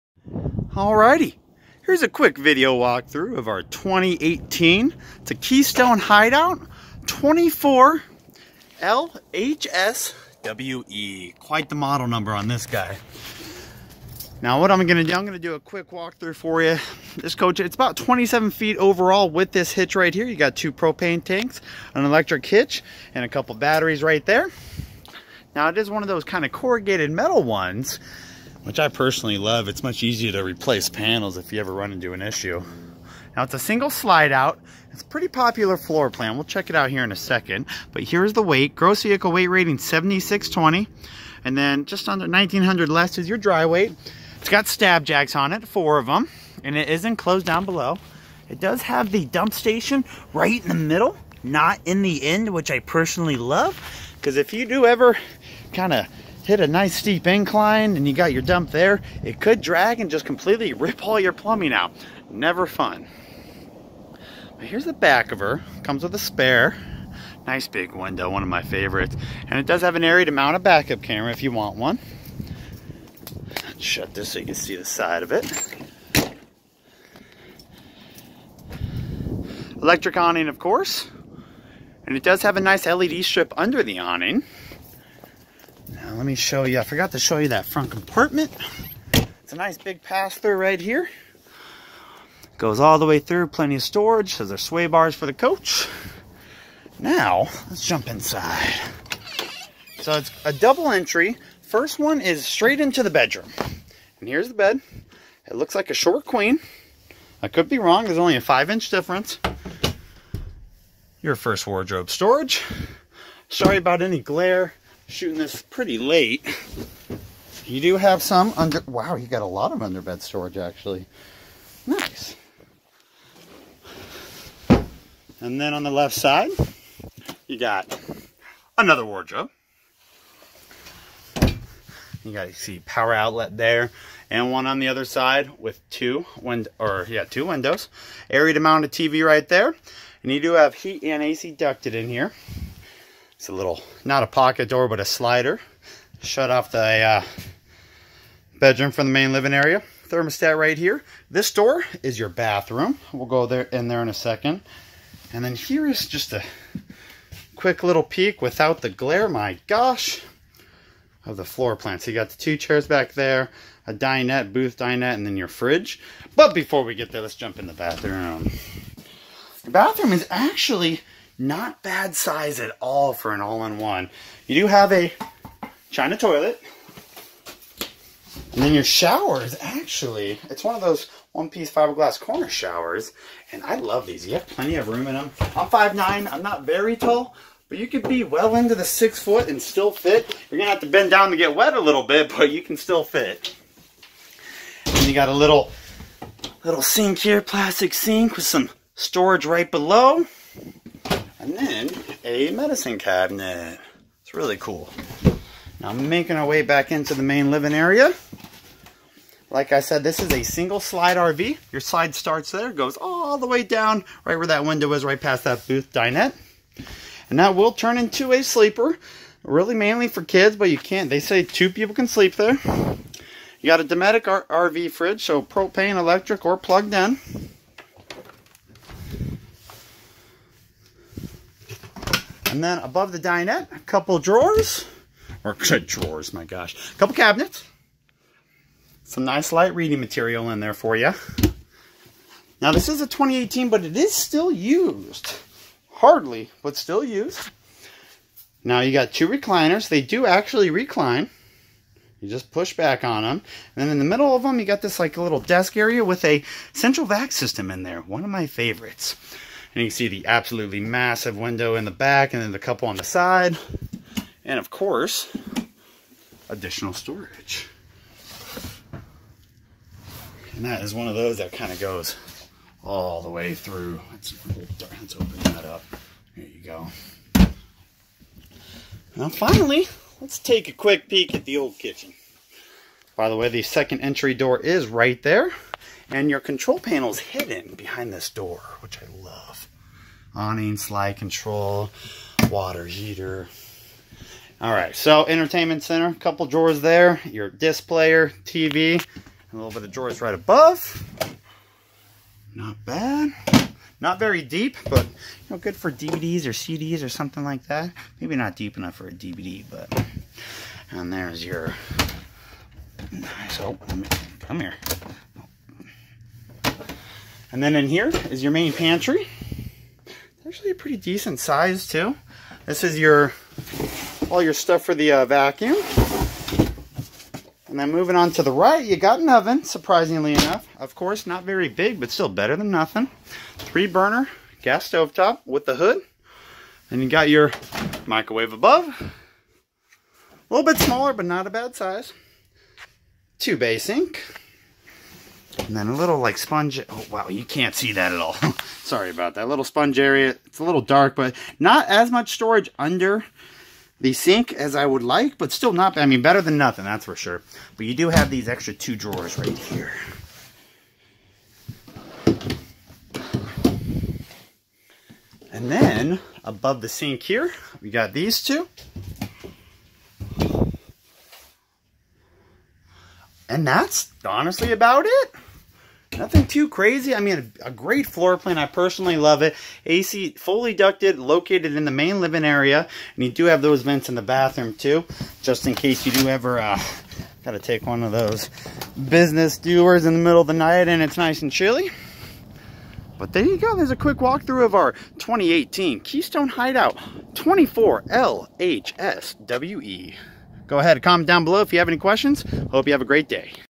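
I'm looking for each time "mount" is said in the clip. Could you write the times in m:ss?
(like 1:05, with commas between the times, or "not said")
1:10, 2:18.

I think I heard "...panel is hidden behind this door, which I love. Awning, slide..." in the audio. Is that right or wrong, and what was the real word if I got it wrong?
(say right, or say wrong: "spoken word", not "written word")
right.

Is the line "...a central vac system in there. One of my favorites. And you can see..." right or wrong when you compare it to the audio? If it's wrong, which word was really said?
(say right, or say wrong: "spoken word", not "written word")
right.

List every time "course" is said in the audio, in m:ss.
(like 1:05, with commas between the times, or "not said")
1:20, 4:24, 5:30.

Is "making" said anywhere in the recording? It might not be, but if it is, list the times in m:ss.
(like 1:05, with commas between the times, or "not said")
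3:26.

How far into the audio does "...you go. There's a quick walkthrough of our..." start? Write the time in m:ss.
6:33.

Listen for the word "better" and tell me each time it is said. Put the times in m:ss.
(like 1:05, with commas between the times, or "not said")
5:32, 5:56.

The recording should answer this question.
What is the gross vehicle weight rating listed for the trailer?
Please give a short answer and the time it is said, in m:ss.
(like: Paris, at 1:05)
7620, at 0:39.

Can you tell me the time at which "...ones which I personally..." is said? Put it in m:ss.
0:27.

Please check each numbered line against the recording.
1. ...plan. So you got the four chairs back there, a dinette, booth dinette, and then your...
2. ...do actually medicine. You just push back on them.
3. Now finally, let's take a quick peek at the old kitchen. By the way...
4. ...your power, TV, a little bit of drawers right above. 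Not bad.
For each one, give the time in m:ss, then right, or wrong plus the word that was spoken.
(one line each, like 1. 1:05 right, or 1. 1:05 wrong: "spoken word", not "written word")
1. 2:41 wrong: "two", not "four"
2. 4:10 wrong: "recline", not "medicine"
3. 4:39 right
4. 4:57 wrong: "displayer", not "power".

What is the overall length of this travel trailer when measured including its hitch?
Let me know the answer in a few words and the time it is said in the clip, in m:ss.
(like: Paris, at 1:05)
27 feet, at 0:17.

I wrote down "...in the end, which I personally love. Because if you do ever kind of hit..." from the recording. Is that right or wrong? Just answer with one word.
right.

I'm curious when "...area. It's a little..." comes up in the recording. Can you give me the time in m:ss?
5:49.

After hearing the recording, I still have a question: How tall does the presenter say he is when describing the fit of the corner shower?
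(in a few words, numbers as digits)
5'9".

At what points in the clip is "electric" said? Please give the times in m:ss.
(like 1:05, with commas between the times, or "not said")
0:22, 1:19, 3:45.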